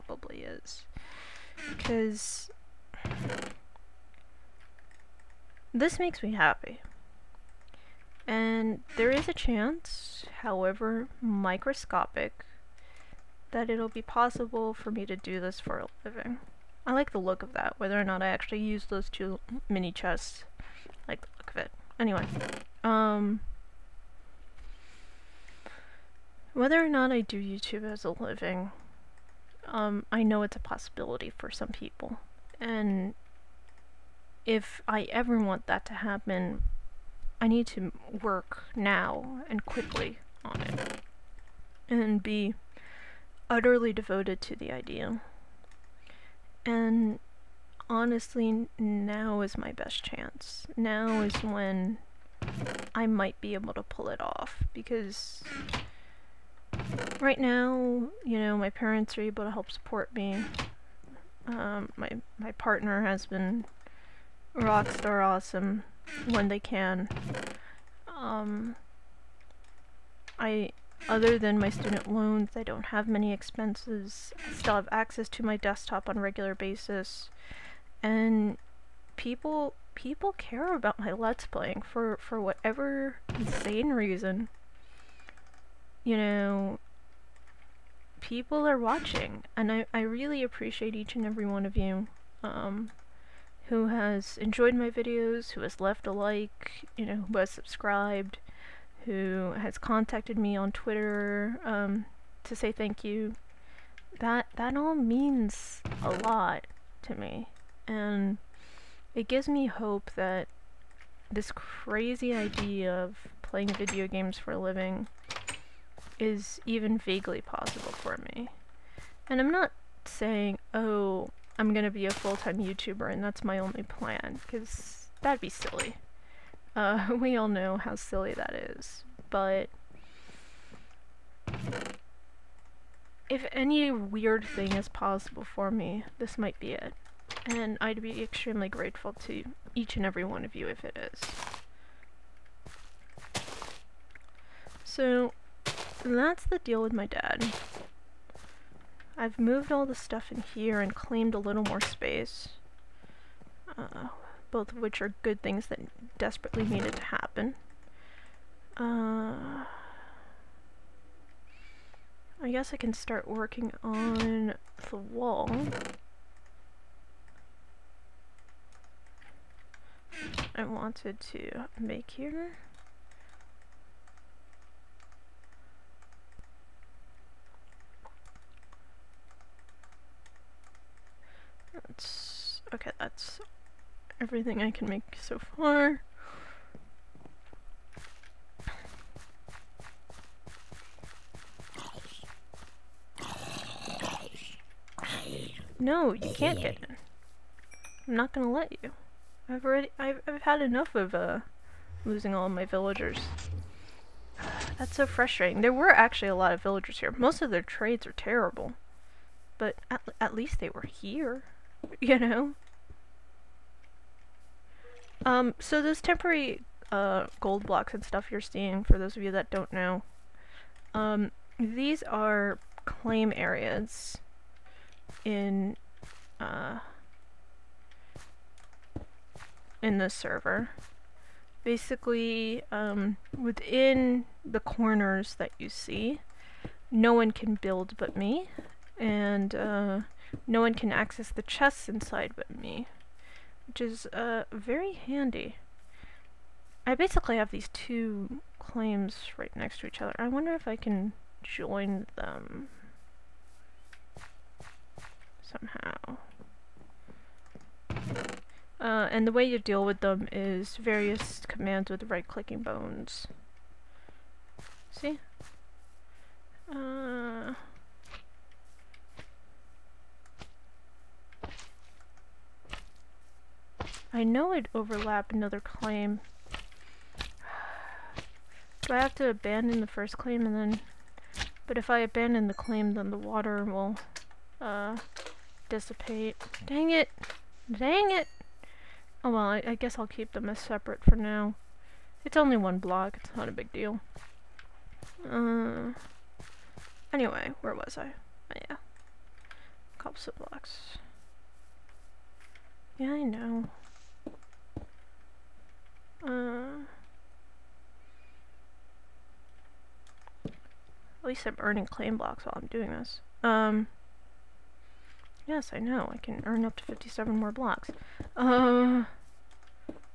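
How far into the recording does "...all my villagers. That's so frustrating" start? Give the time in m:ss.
3:22.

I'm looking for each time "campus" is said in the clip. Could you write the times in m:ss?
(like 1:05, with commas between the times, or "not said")
not said.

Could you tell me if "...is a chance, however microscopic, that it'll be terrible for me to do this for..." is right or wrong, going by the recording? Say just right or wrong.
wrong.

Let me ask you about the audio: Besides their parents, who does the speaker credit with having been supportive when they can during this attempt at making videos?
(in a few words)
partner.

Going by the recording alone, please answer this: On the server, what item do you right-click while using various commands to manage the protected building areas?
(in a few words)
bones.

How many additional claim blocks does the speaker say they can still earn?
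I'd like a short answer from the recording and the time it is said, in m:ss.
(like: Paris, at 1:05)
57, at 5:16.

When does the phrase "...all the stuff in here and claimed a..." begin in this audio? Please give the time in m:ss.
2:29.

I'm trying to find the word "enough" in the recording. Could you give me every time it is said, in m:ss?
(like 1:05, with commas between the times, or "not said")
3:20.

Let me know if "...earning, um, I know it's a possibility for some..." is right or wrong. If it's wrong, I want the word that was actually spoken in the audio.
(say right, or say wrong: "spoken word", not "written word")
wrong: "living", not "earning".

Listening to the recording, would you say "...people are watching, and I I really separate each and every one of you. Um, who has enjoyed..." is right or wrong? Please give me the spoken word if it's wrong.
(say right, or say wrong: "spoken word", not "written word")
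wrong: "appreciate", not "separate".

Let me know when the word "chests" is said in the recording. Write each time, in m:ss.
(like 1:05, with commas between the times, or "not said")
0:19, 4:01.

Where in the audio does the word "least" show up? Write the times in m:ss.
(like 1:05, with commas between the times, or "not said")
3:30, 5:11.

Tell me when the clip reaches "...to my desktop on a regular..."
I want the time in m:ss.
1:15.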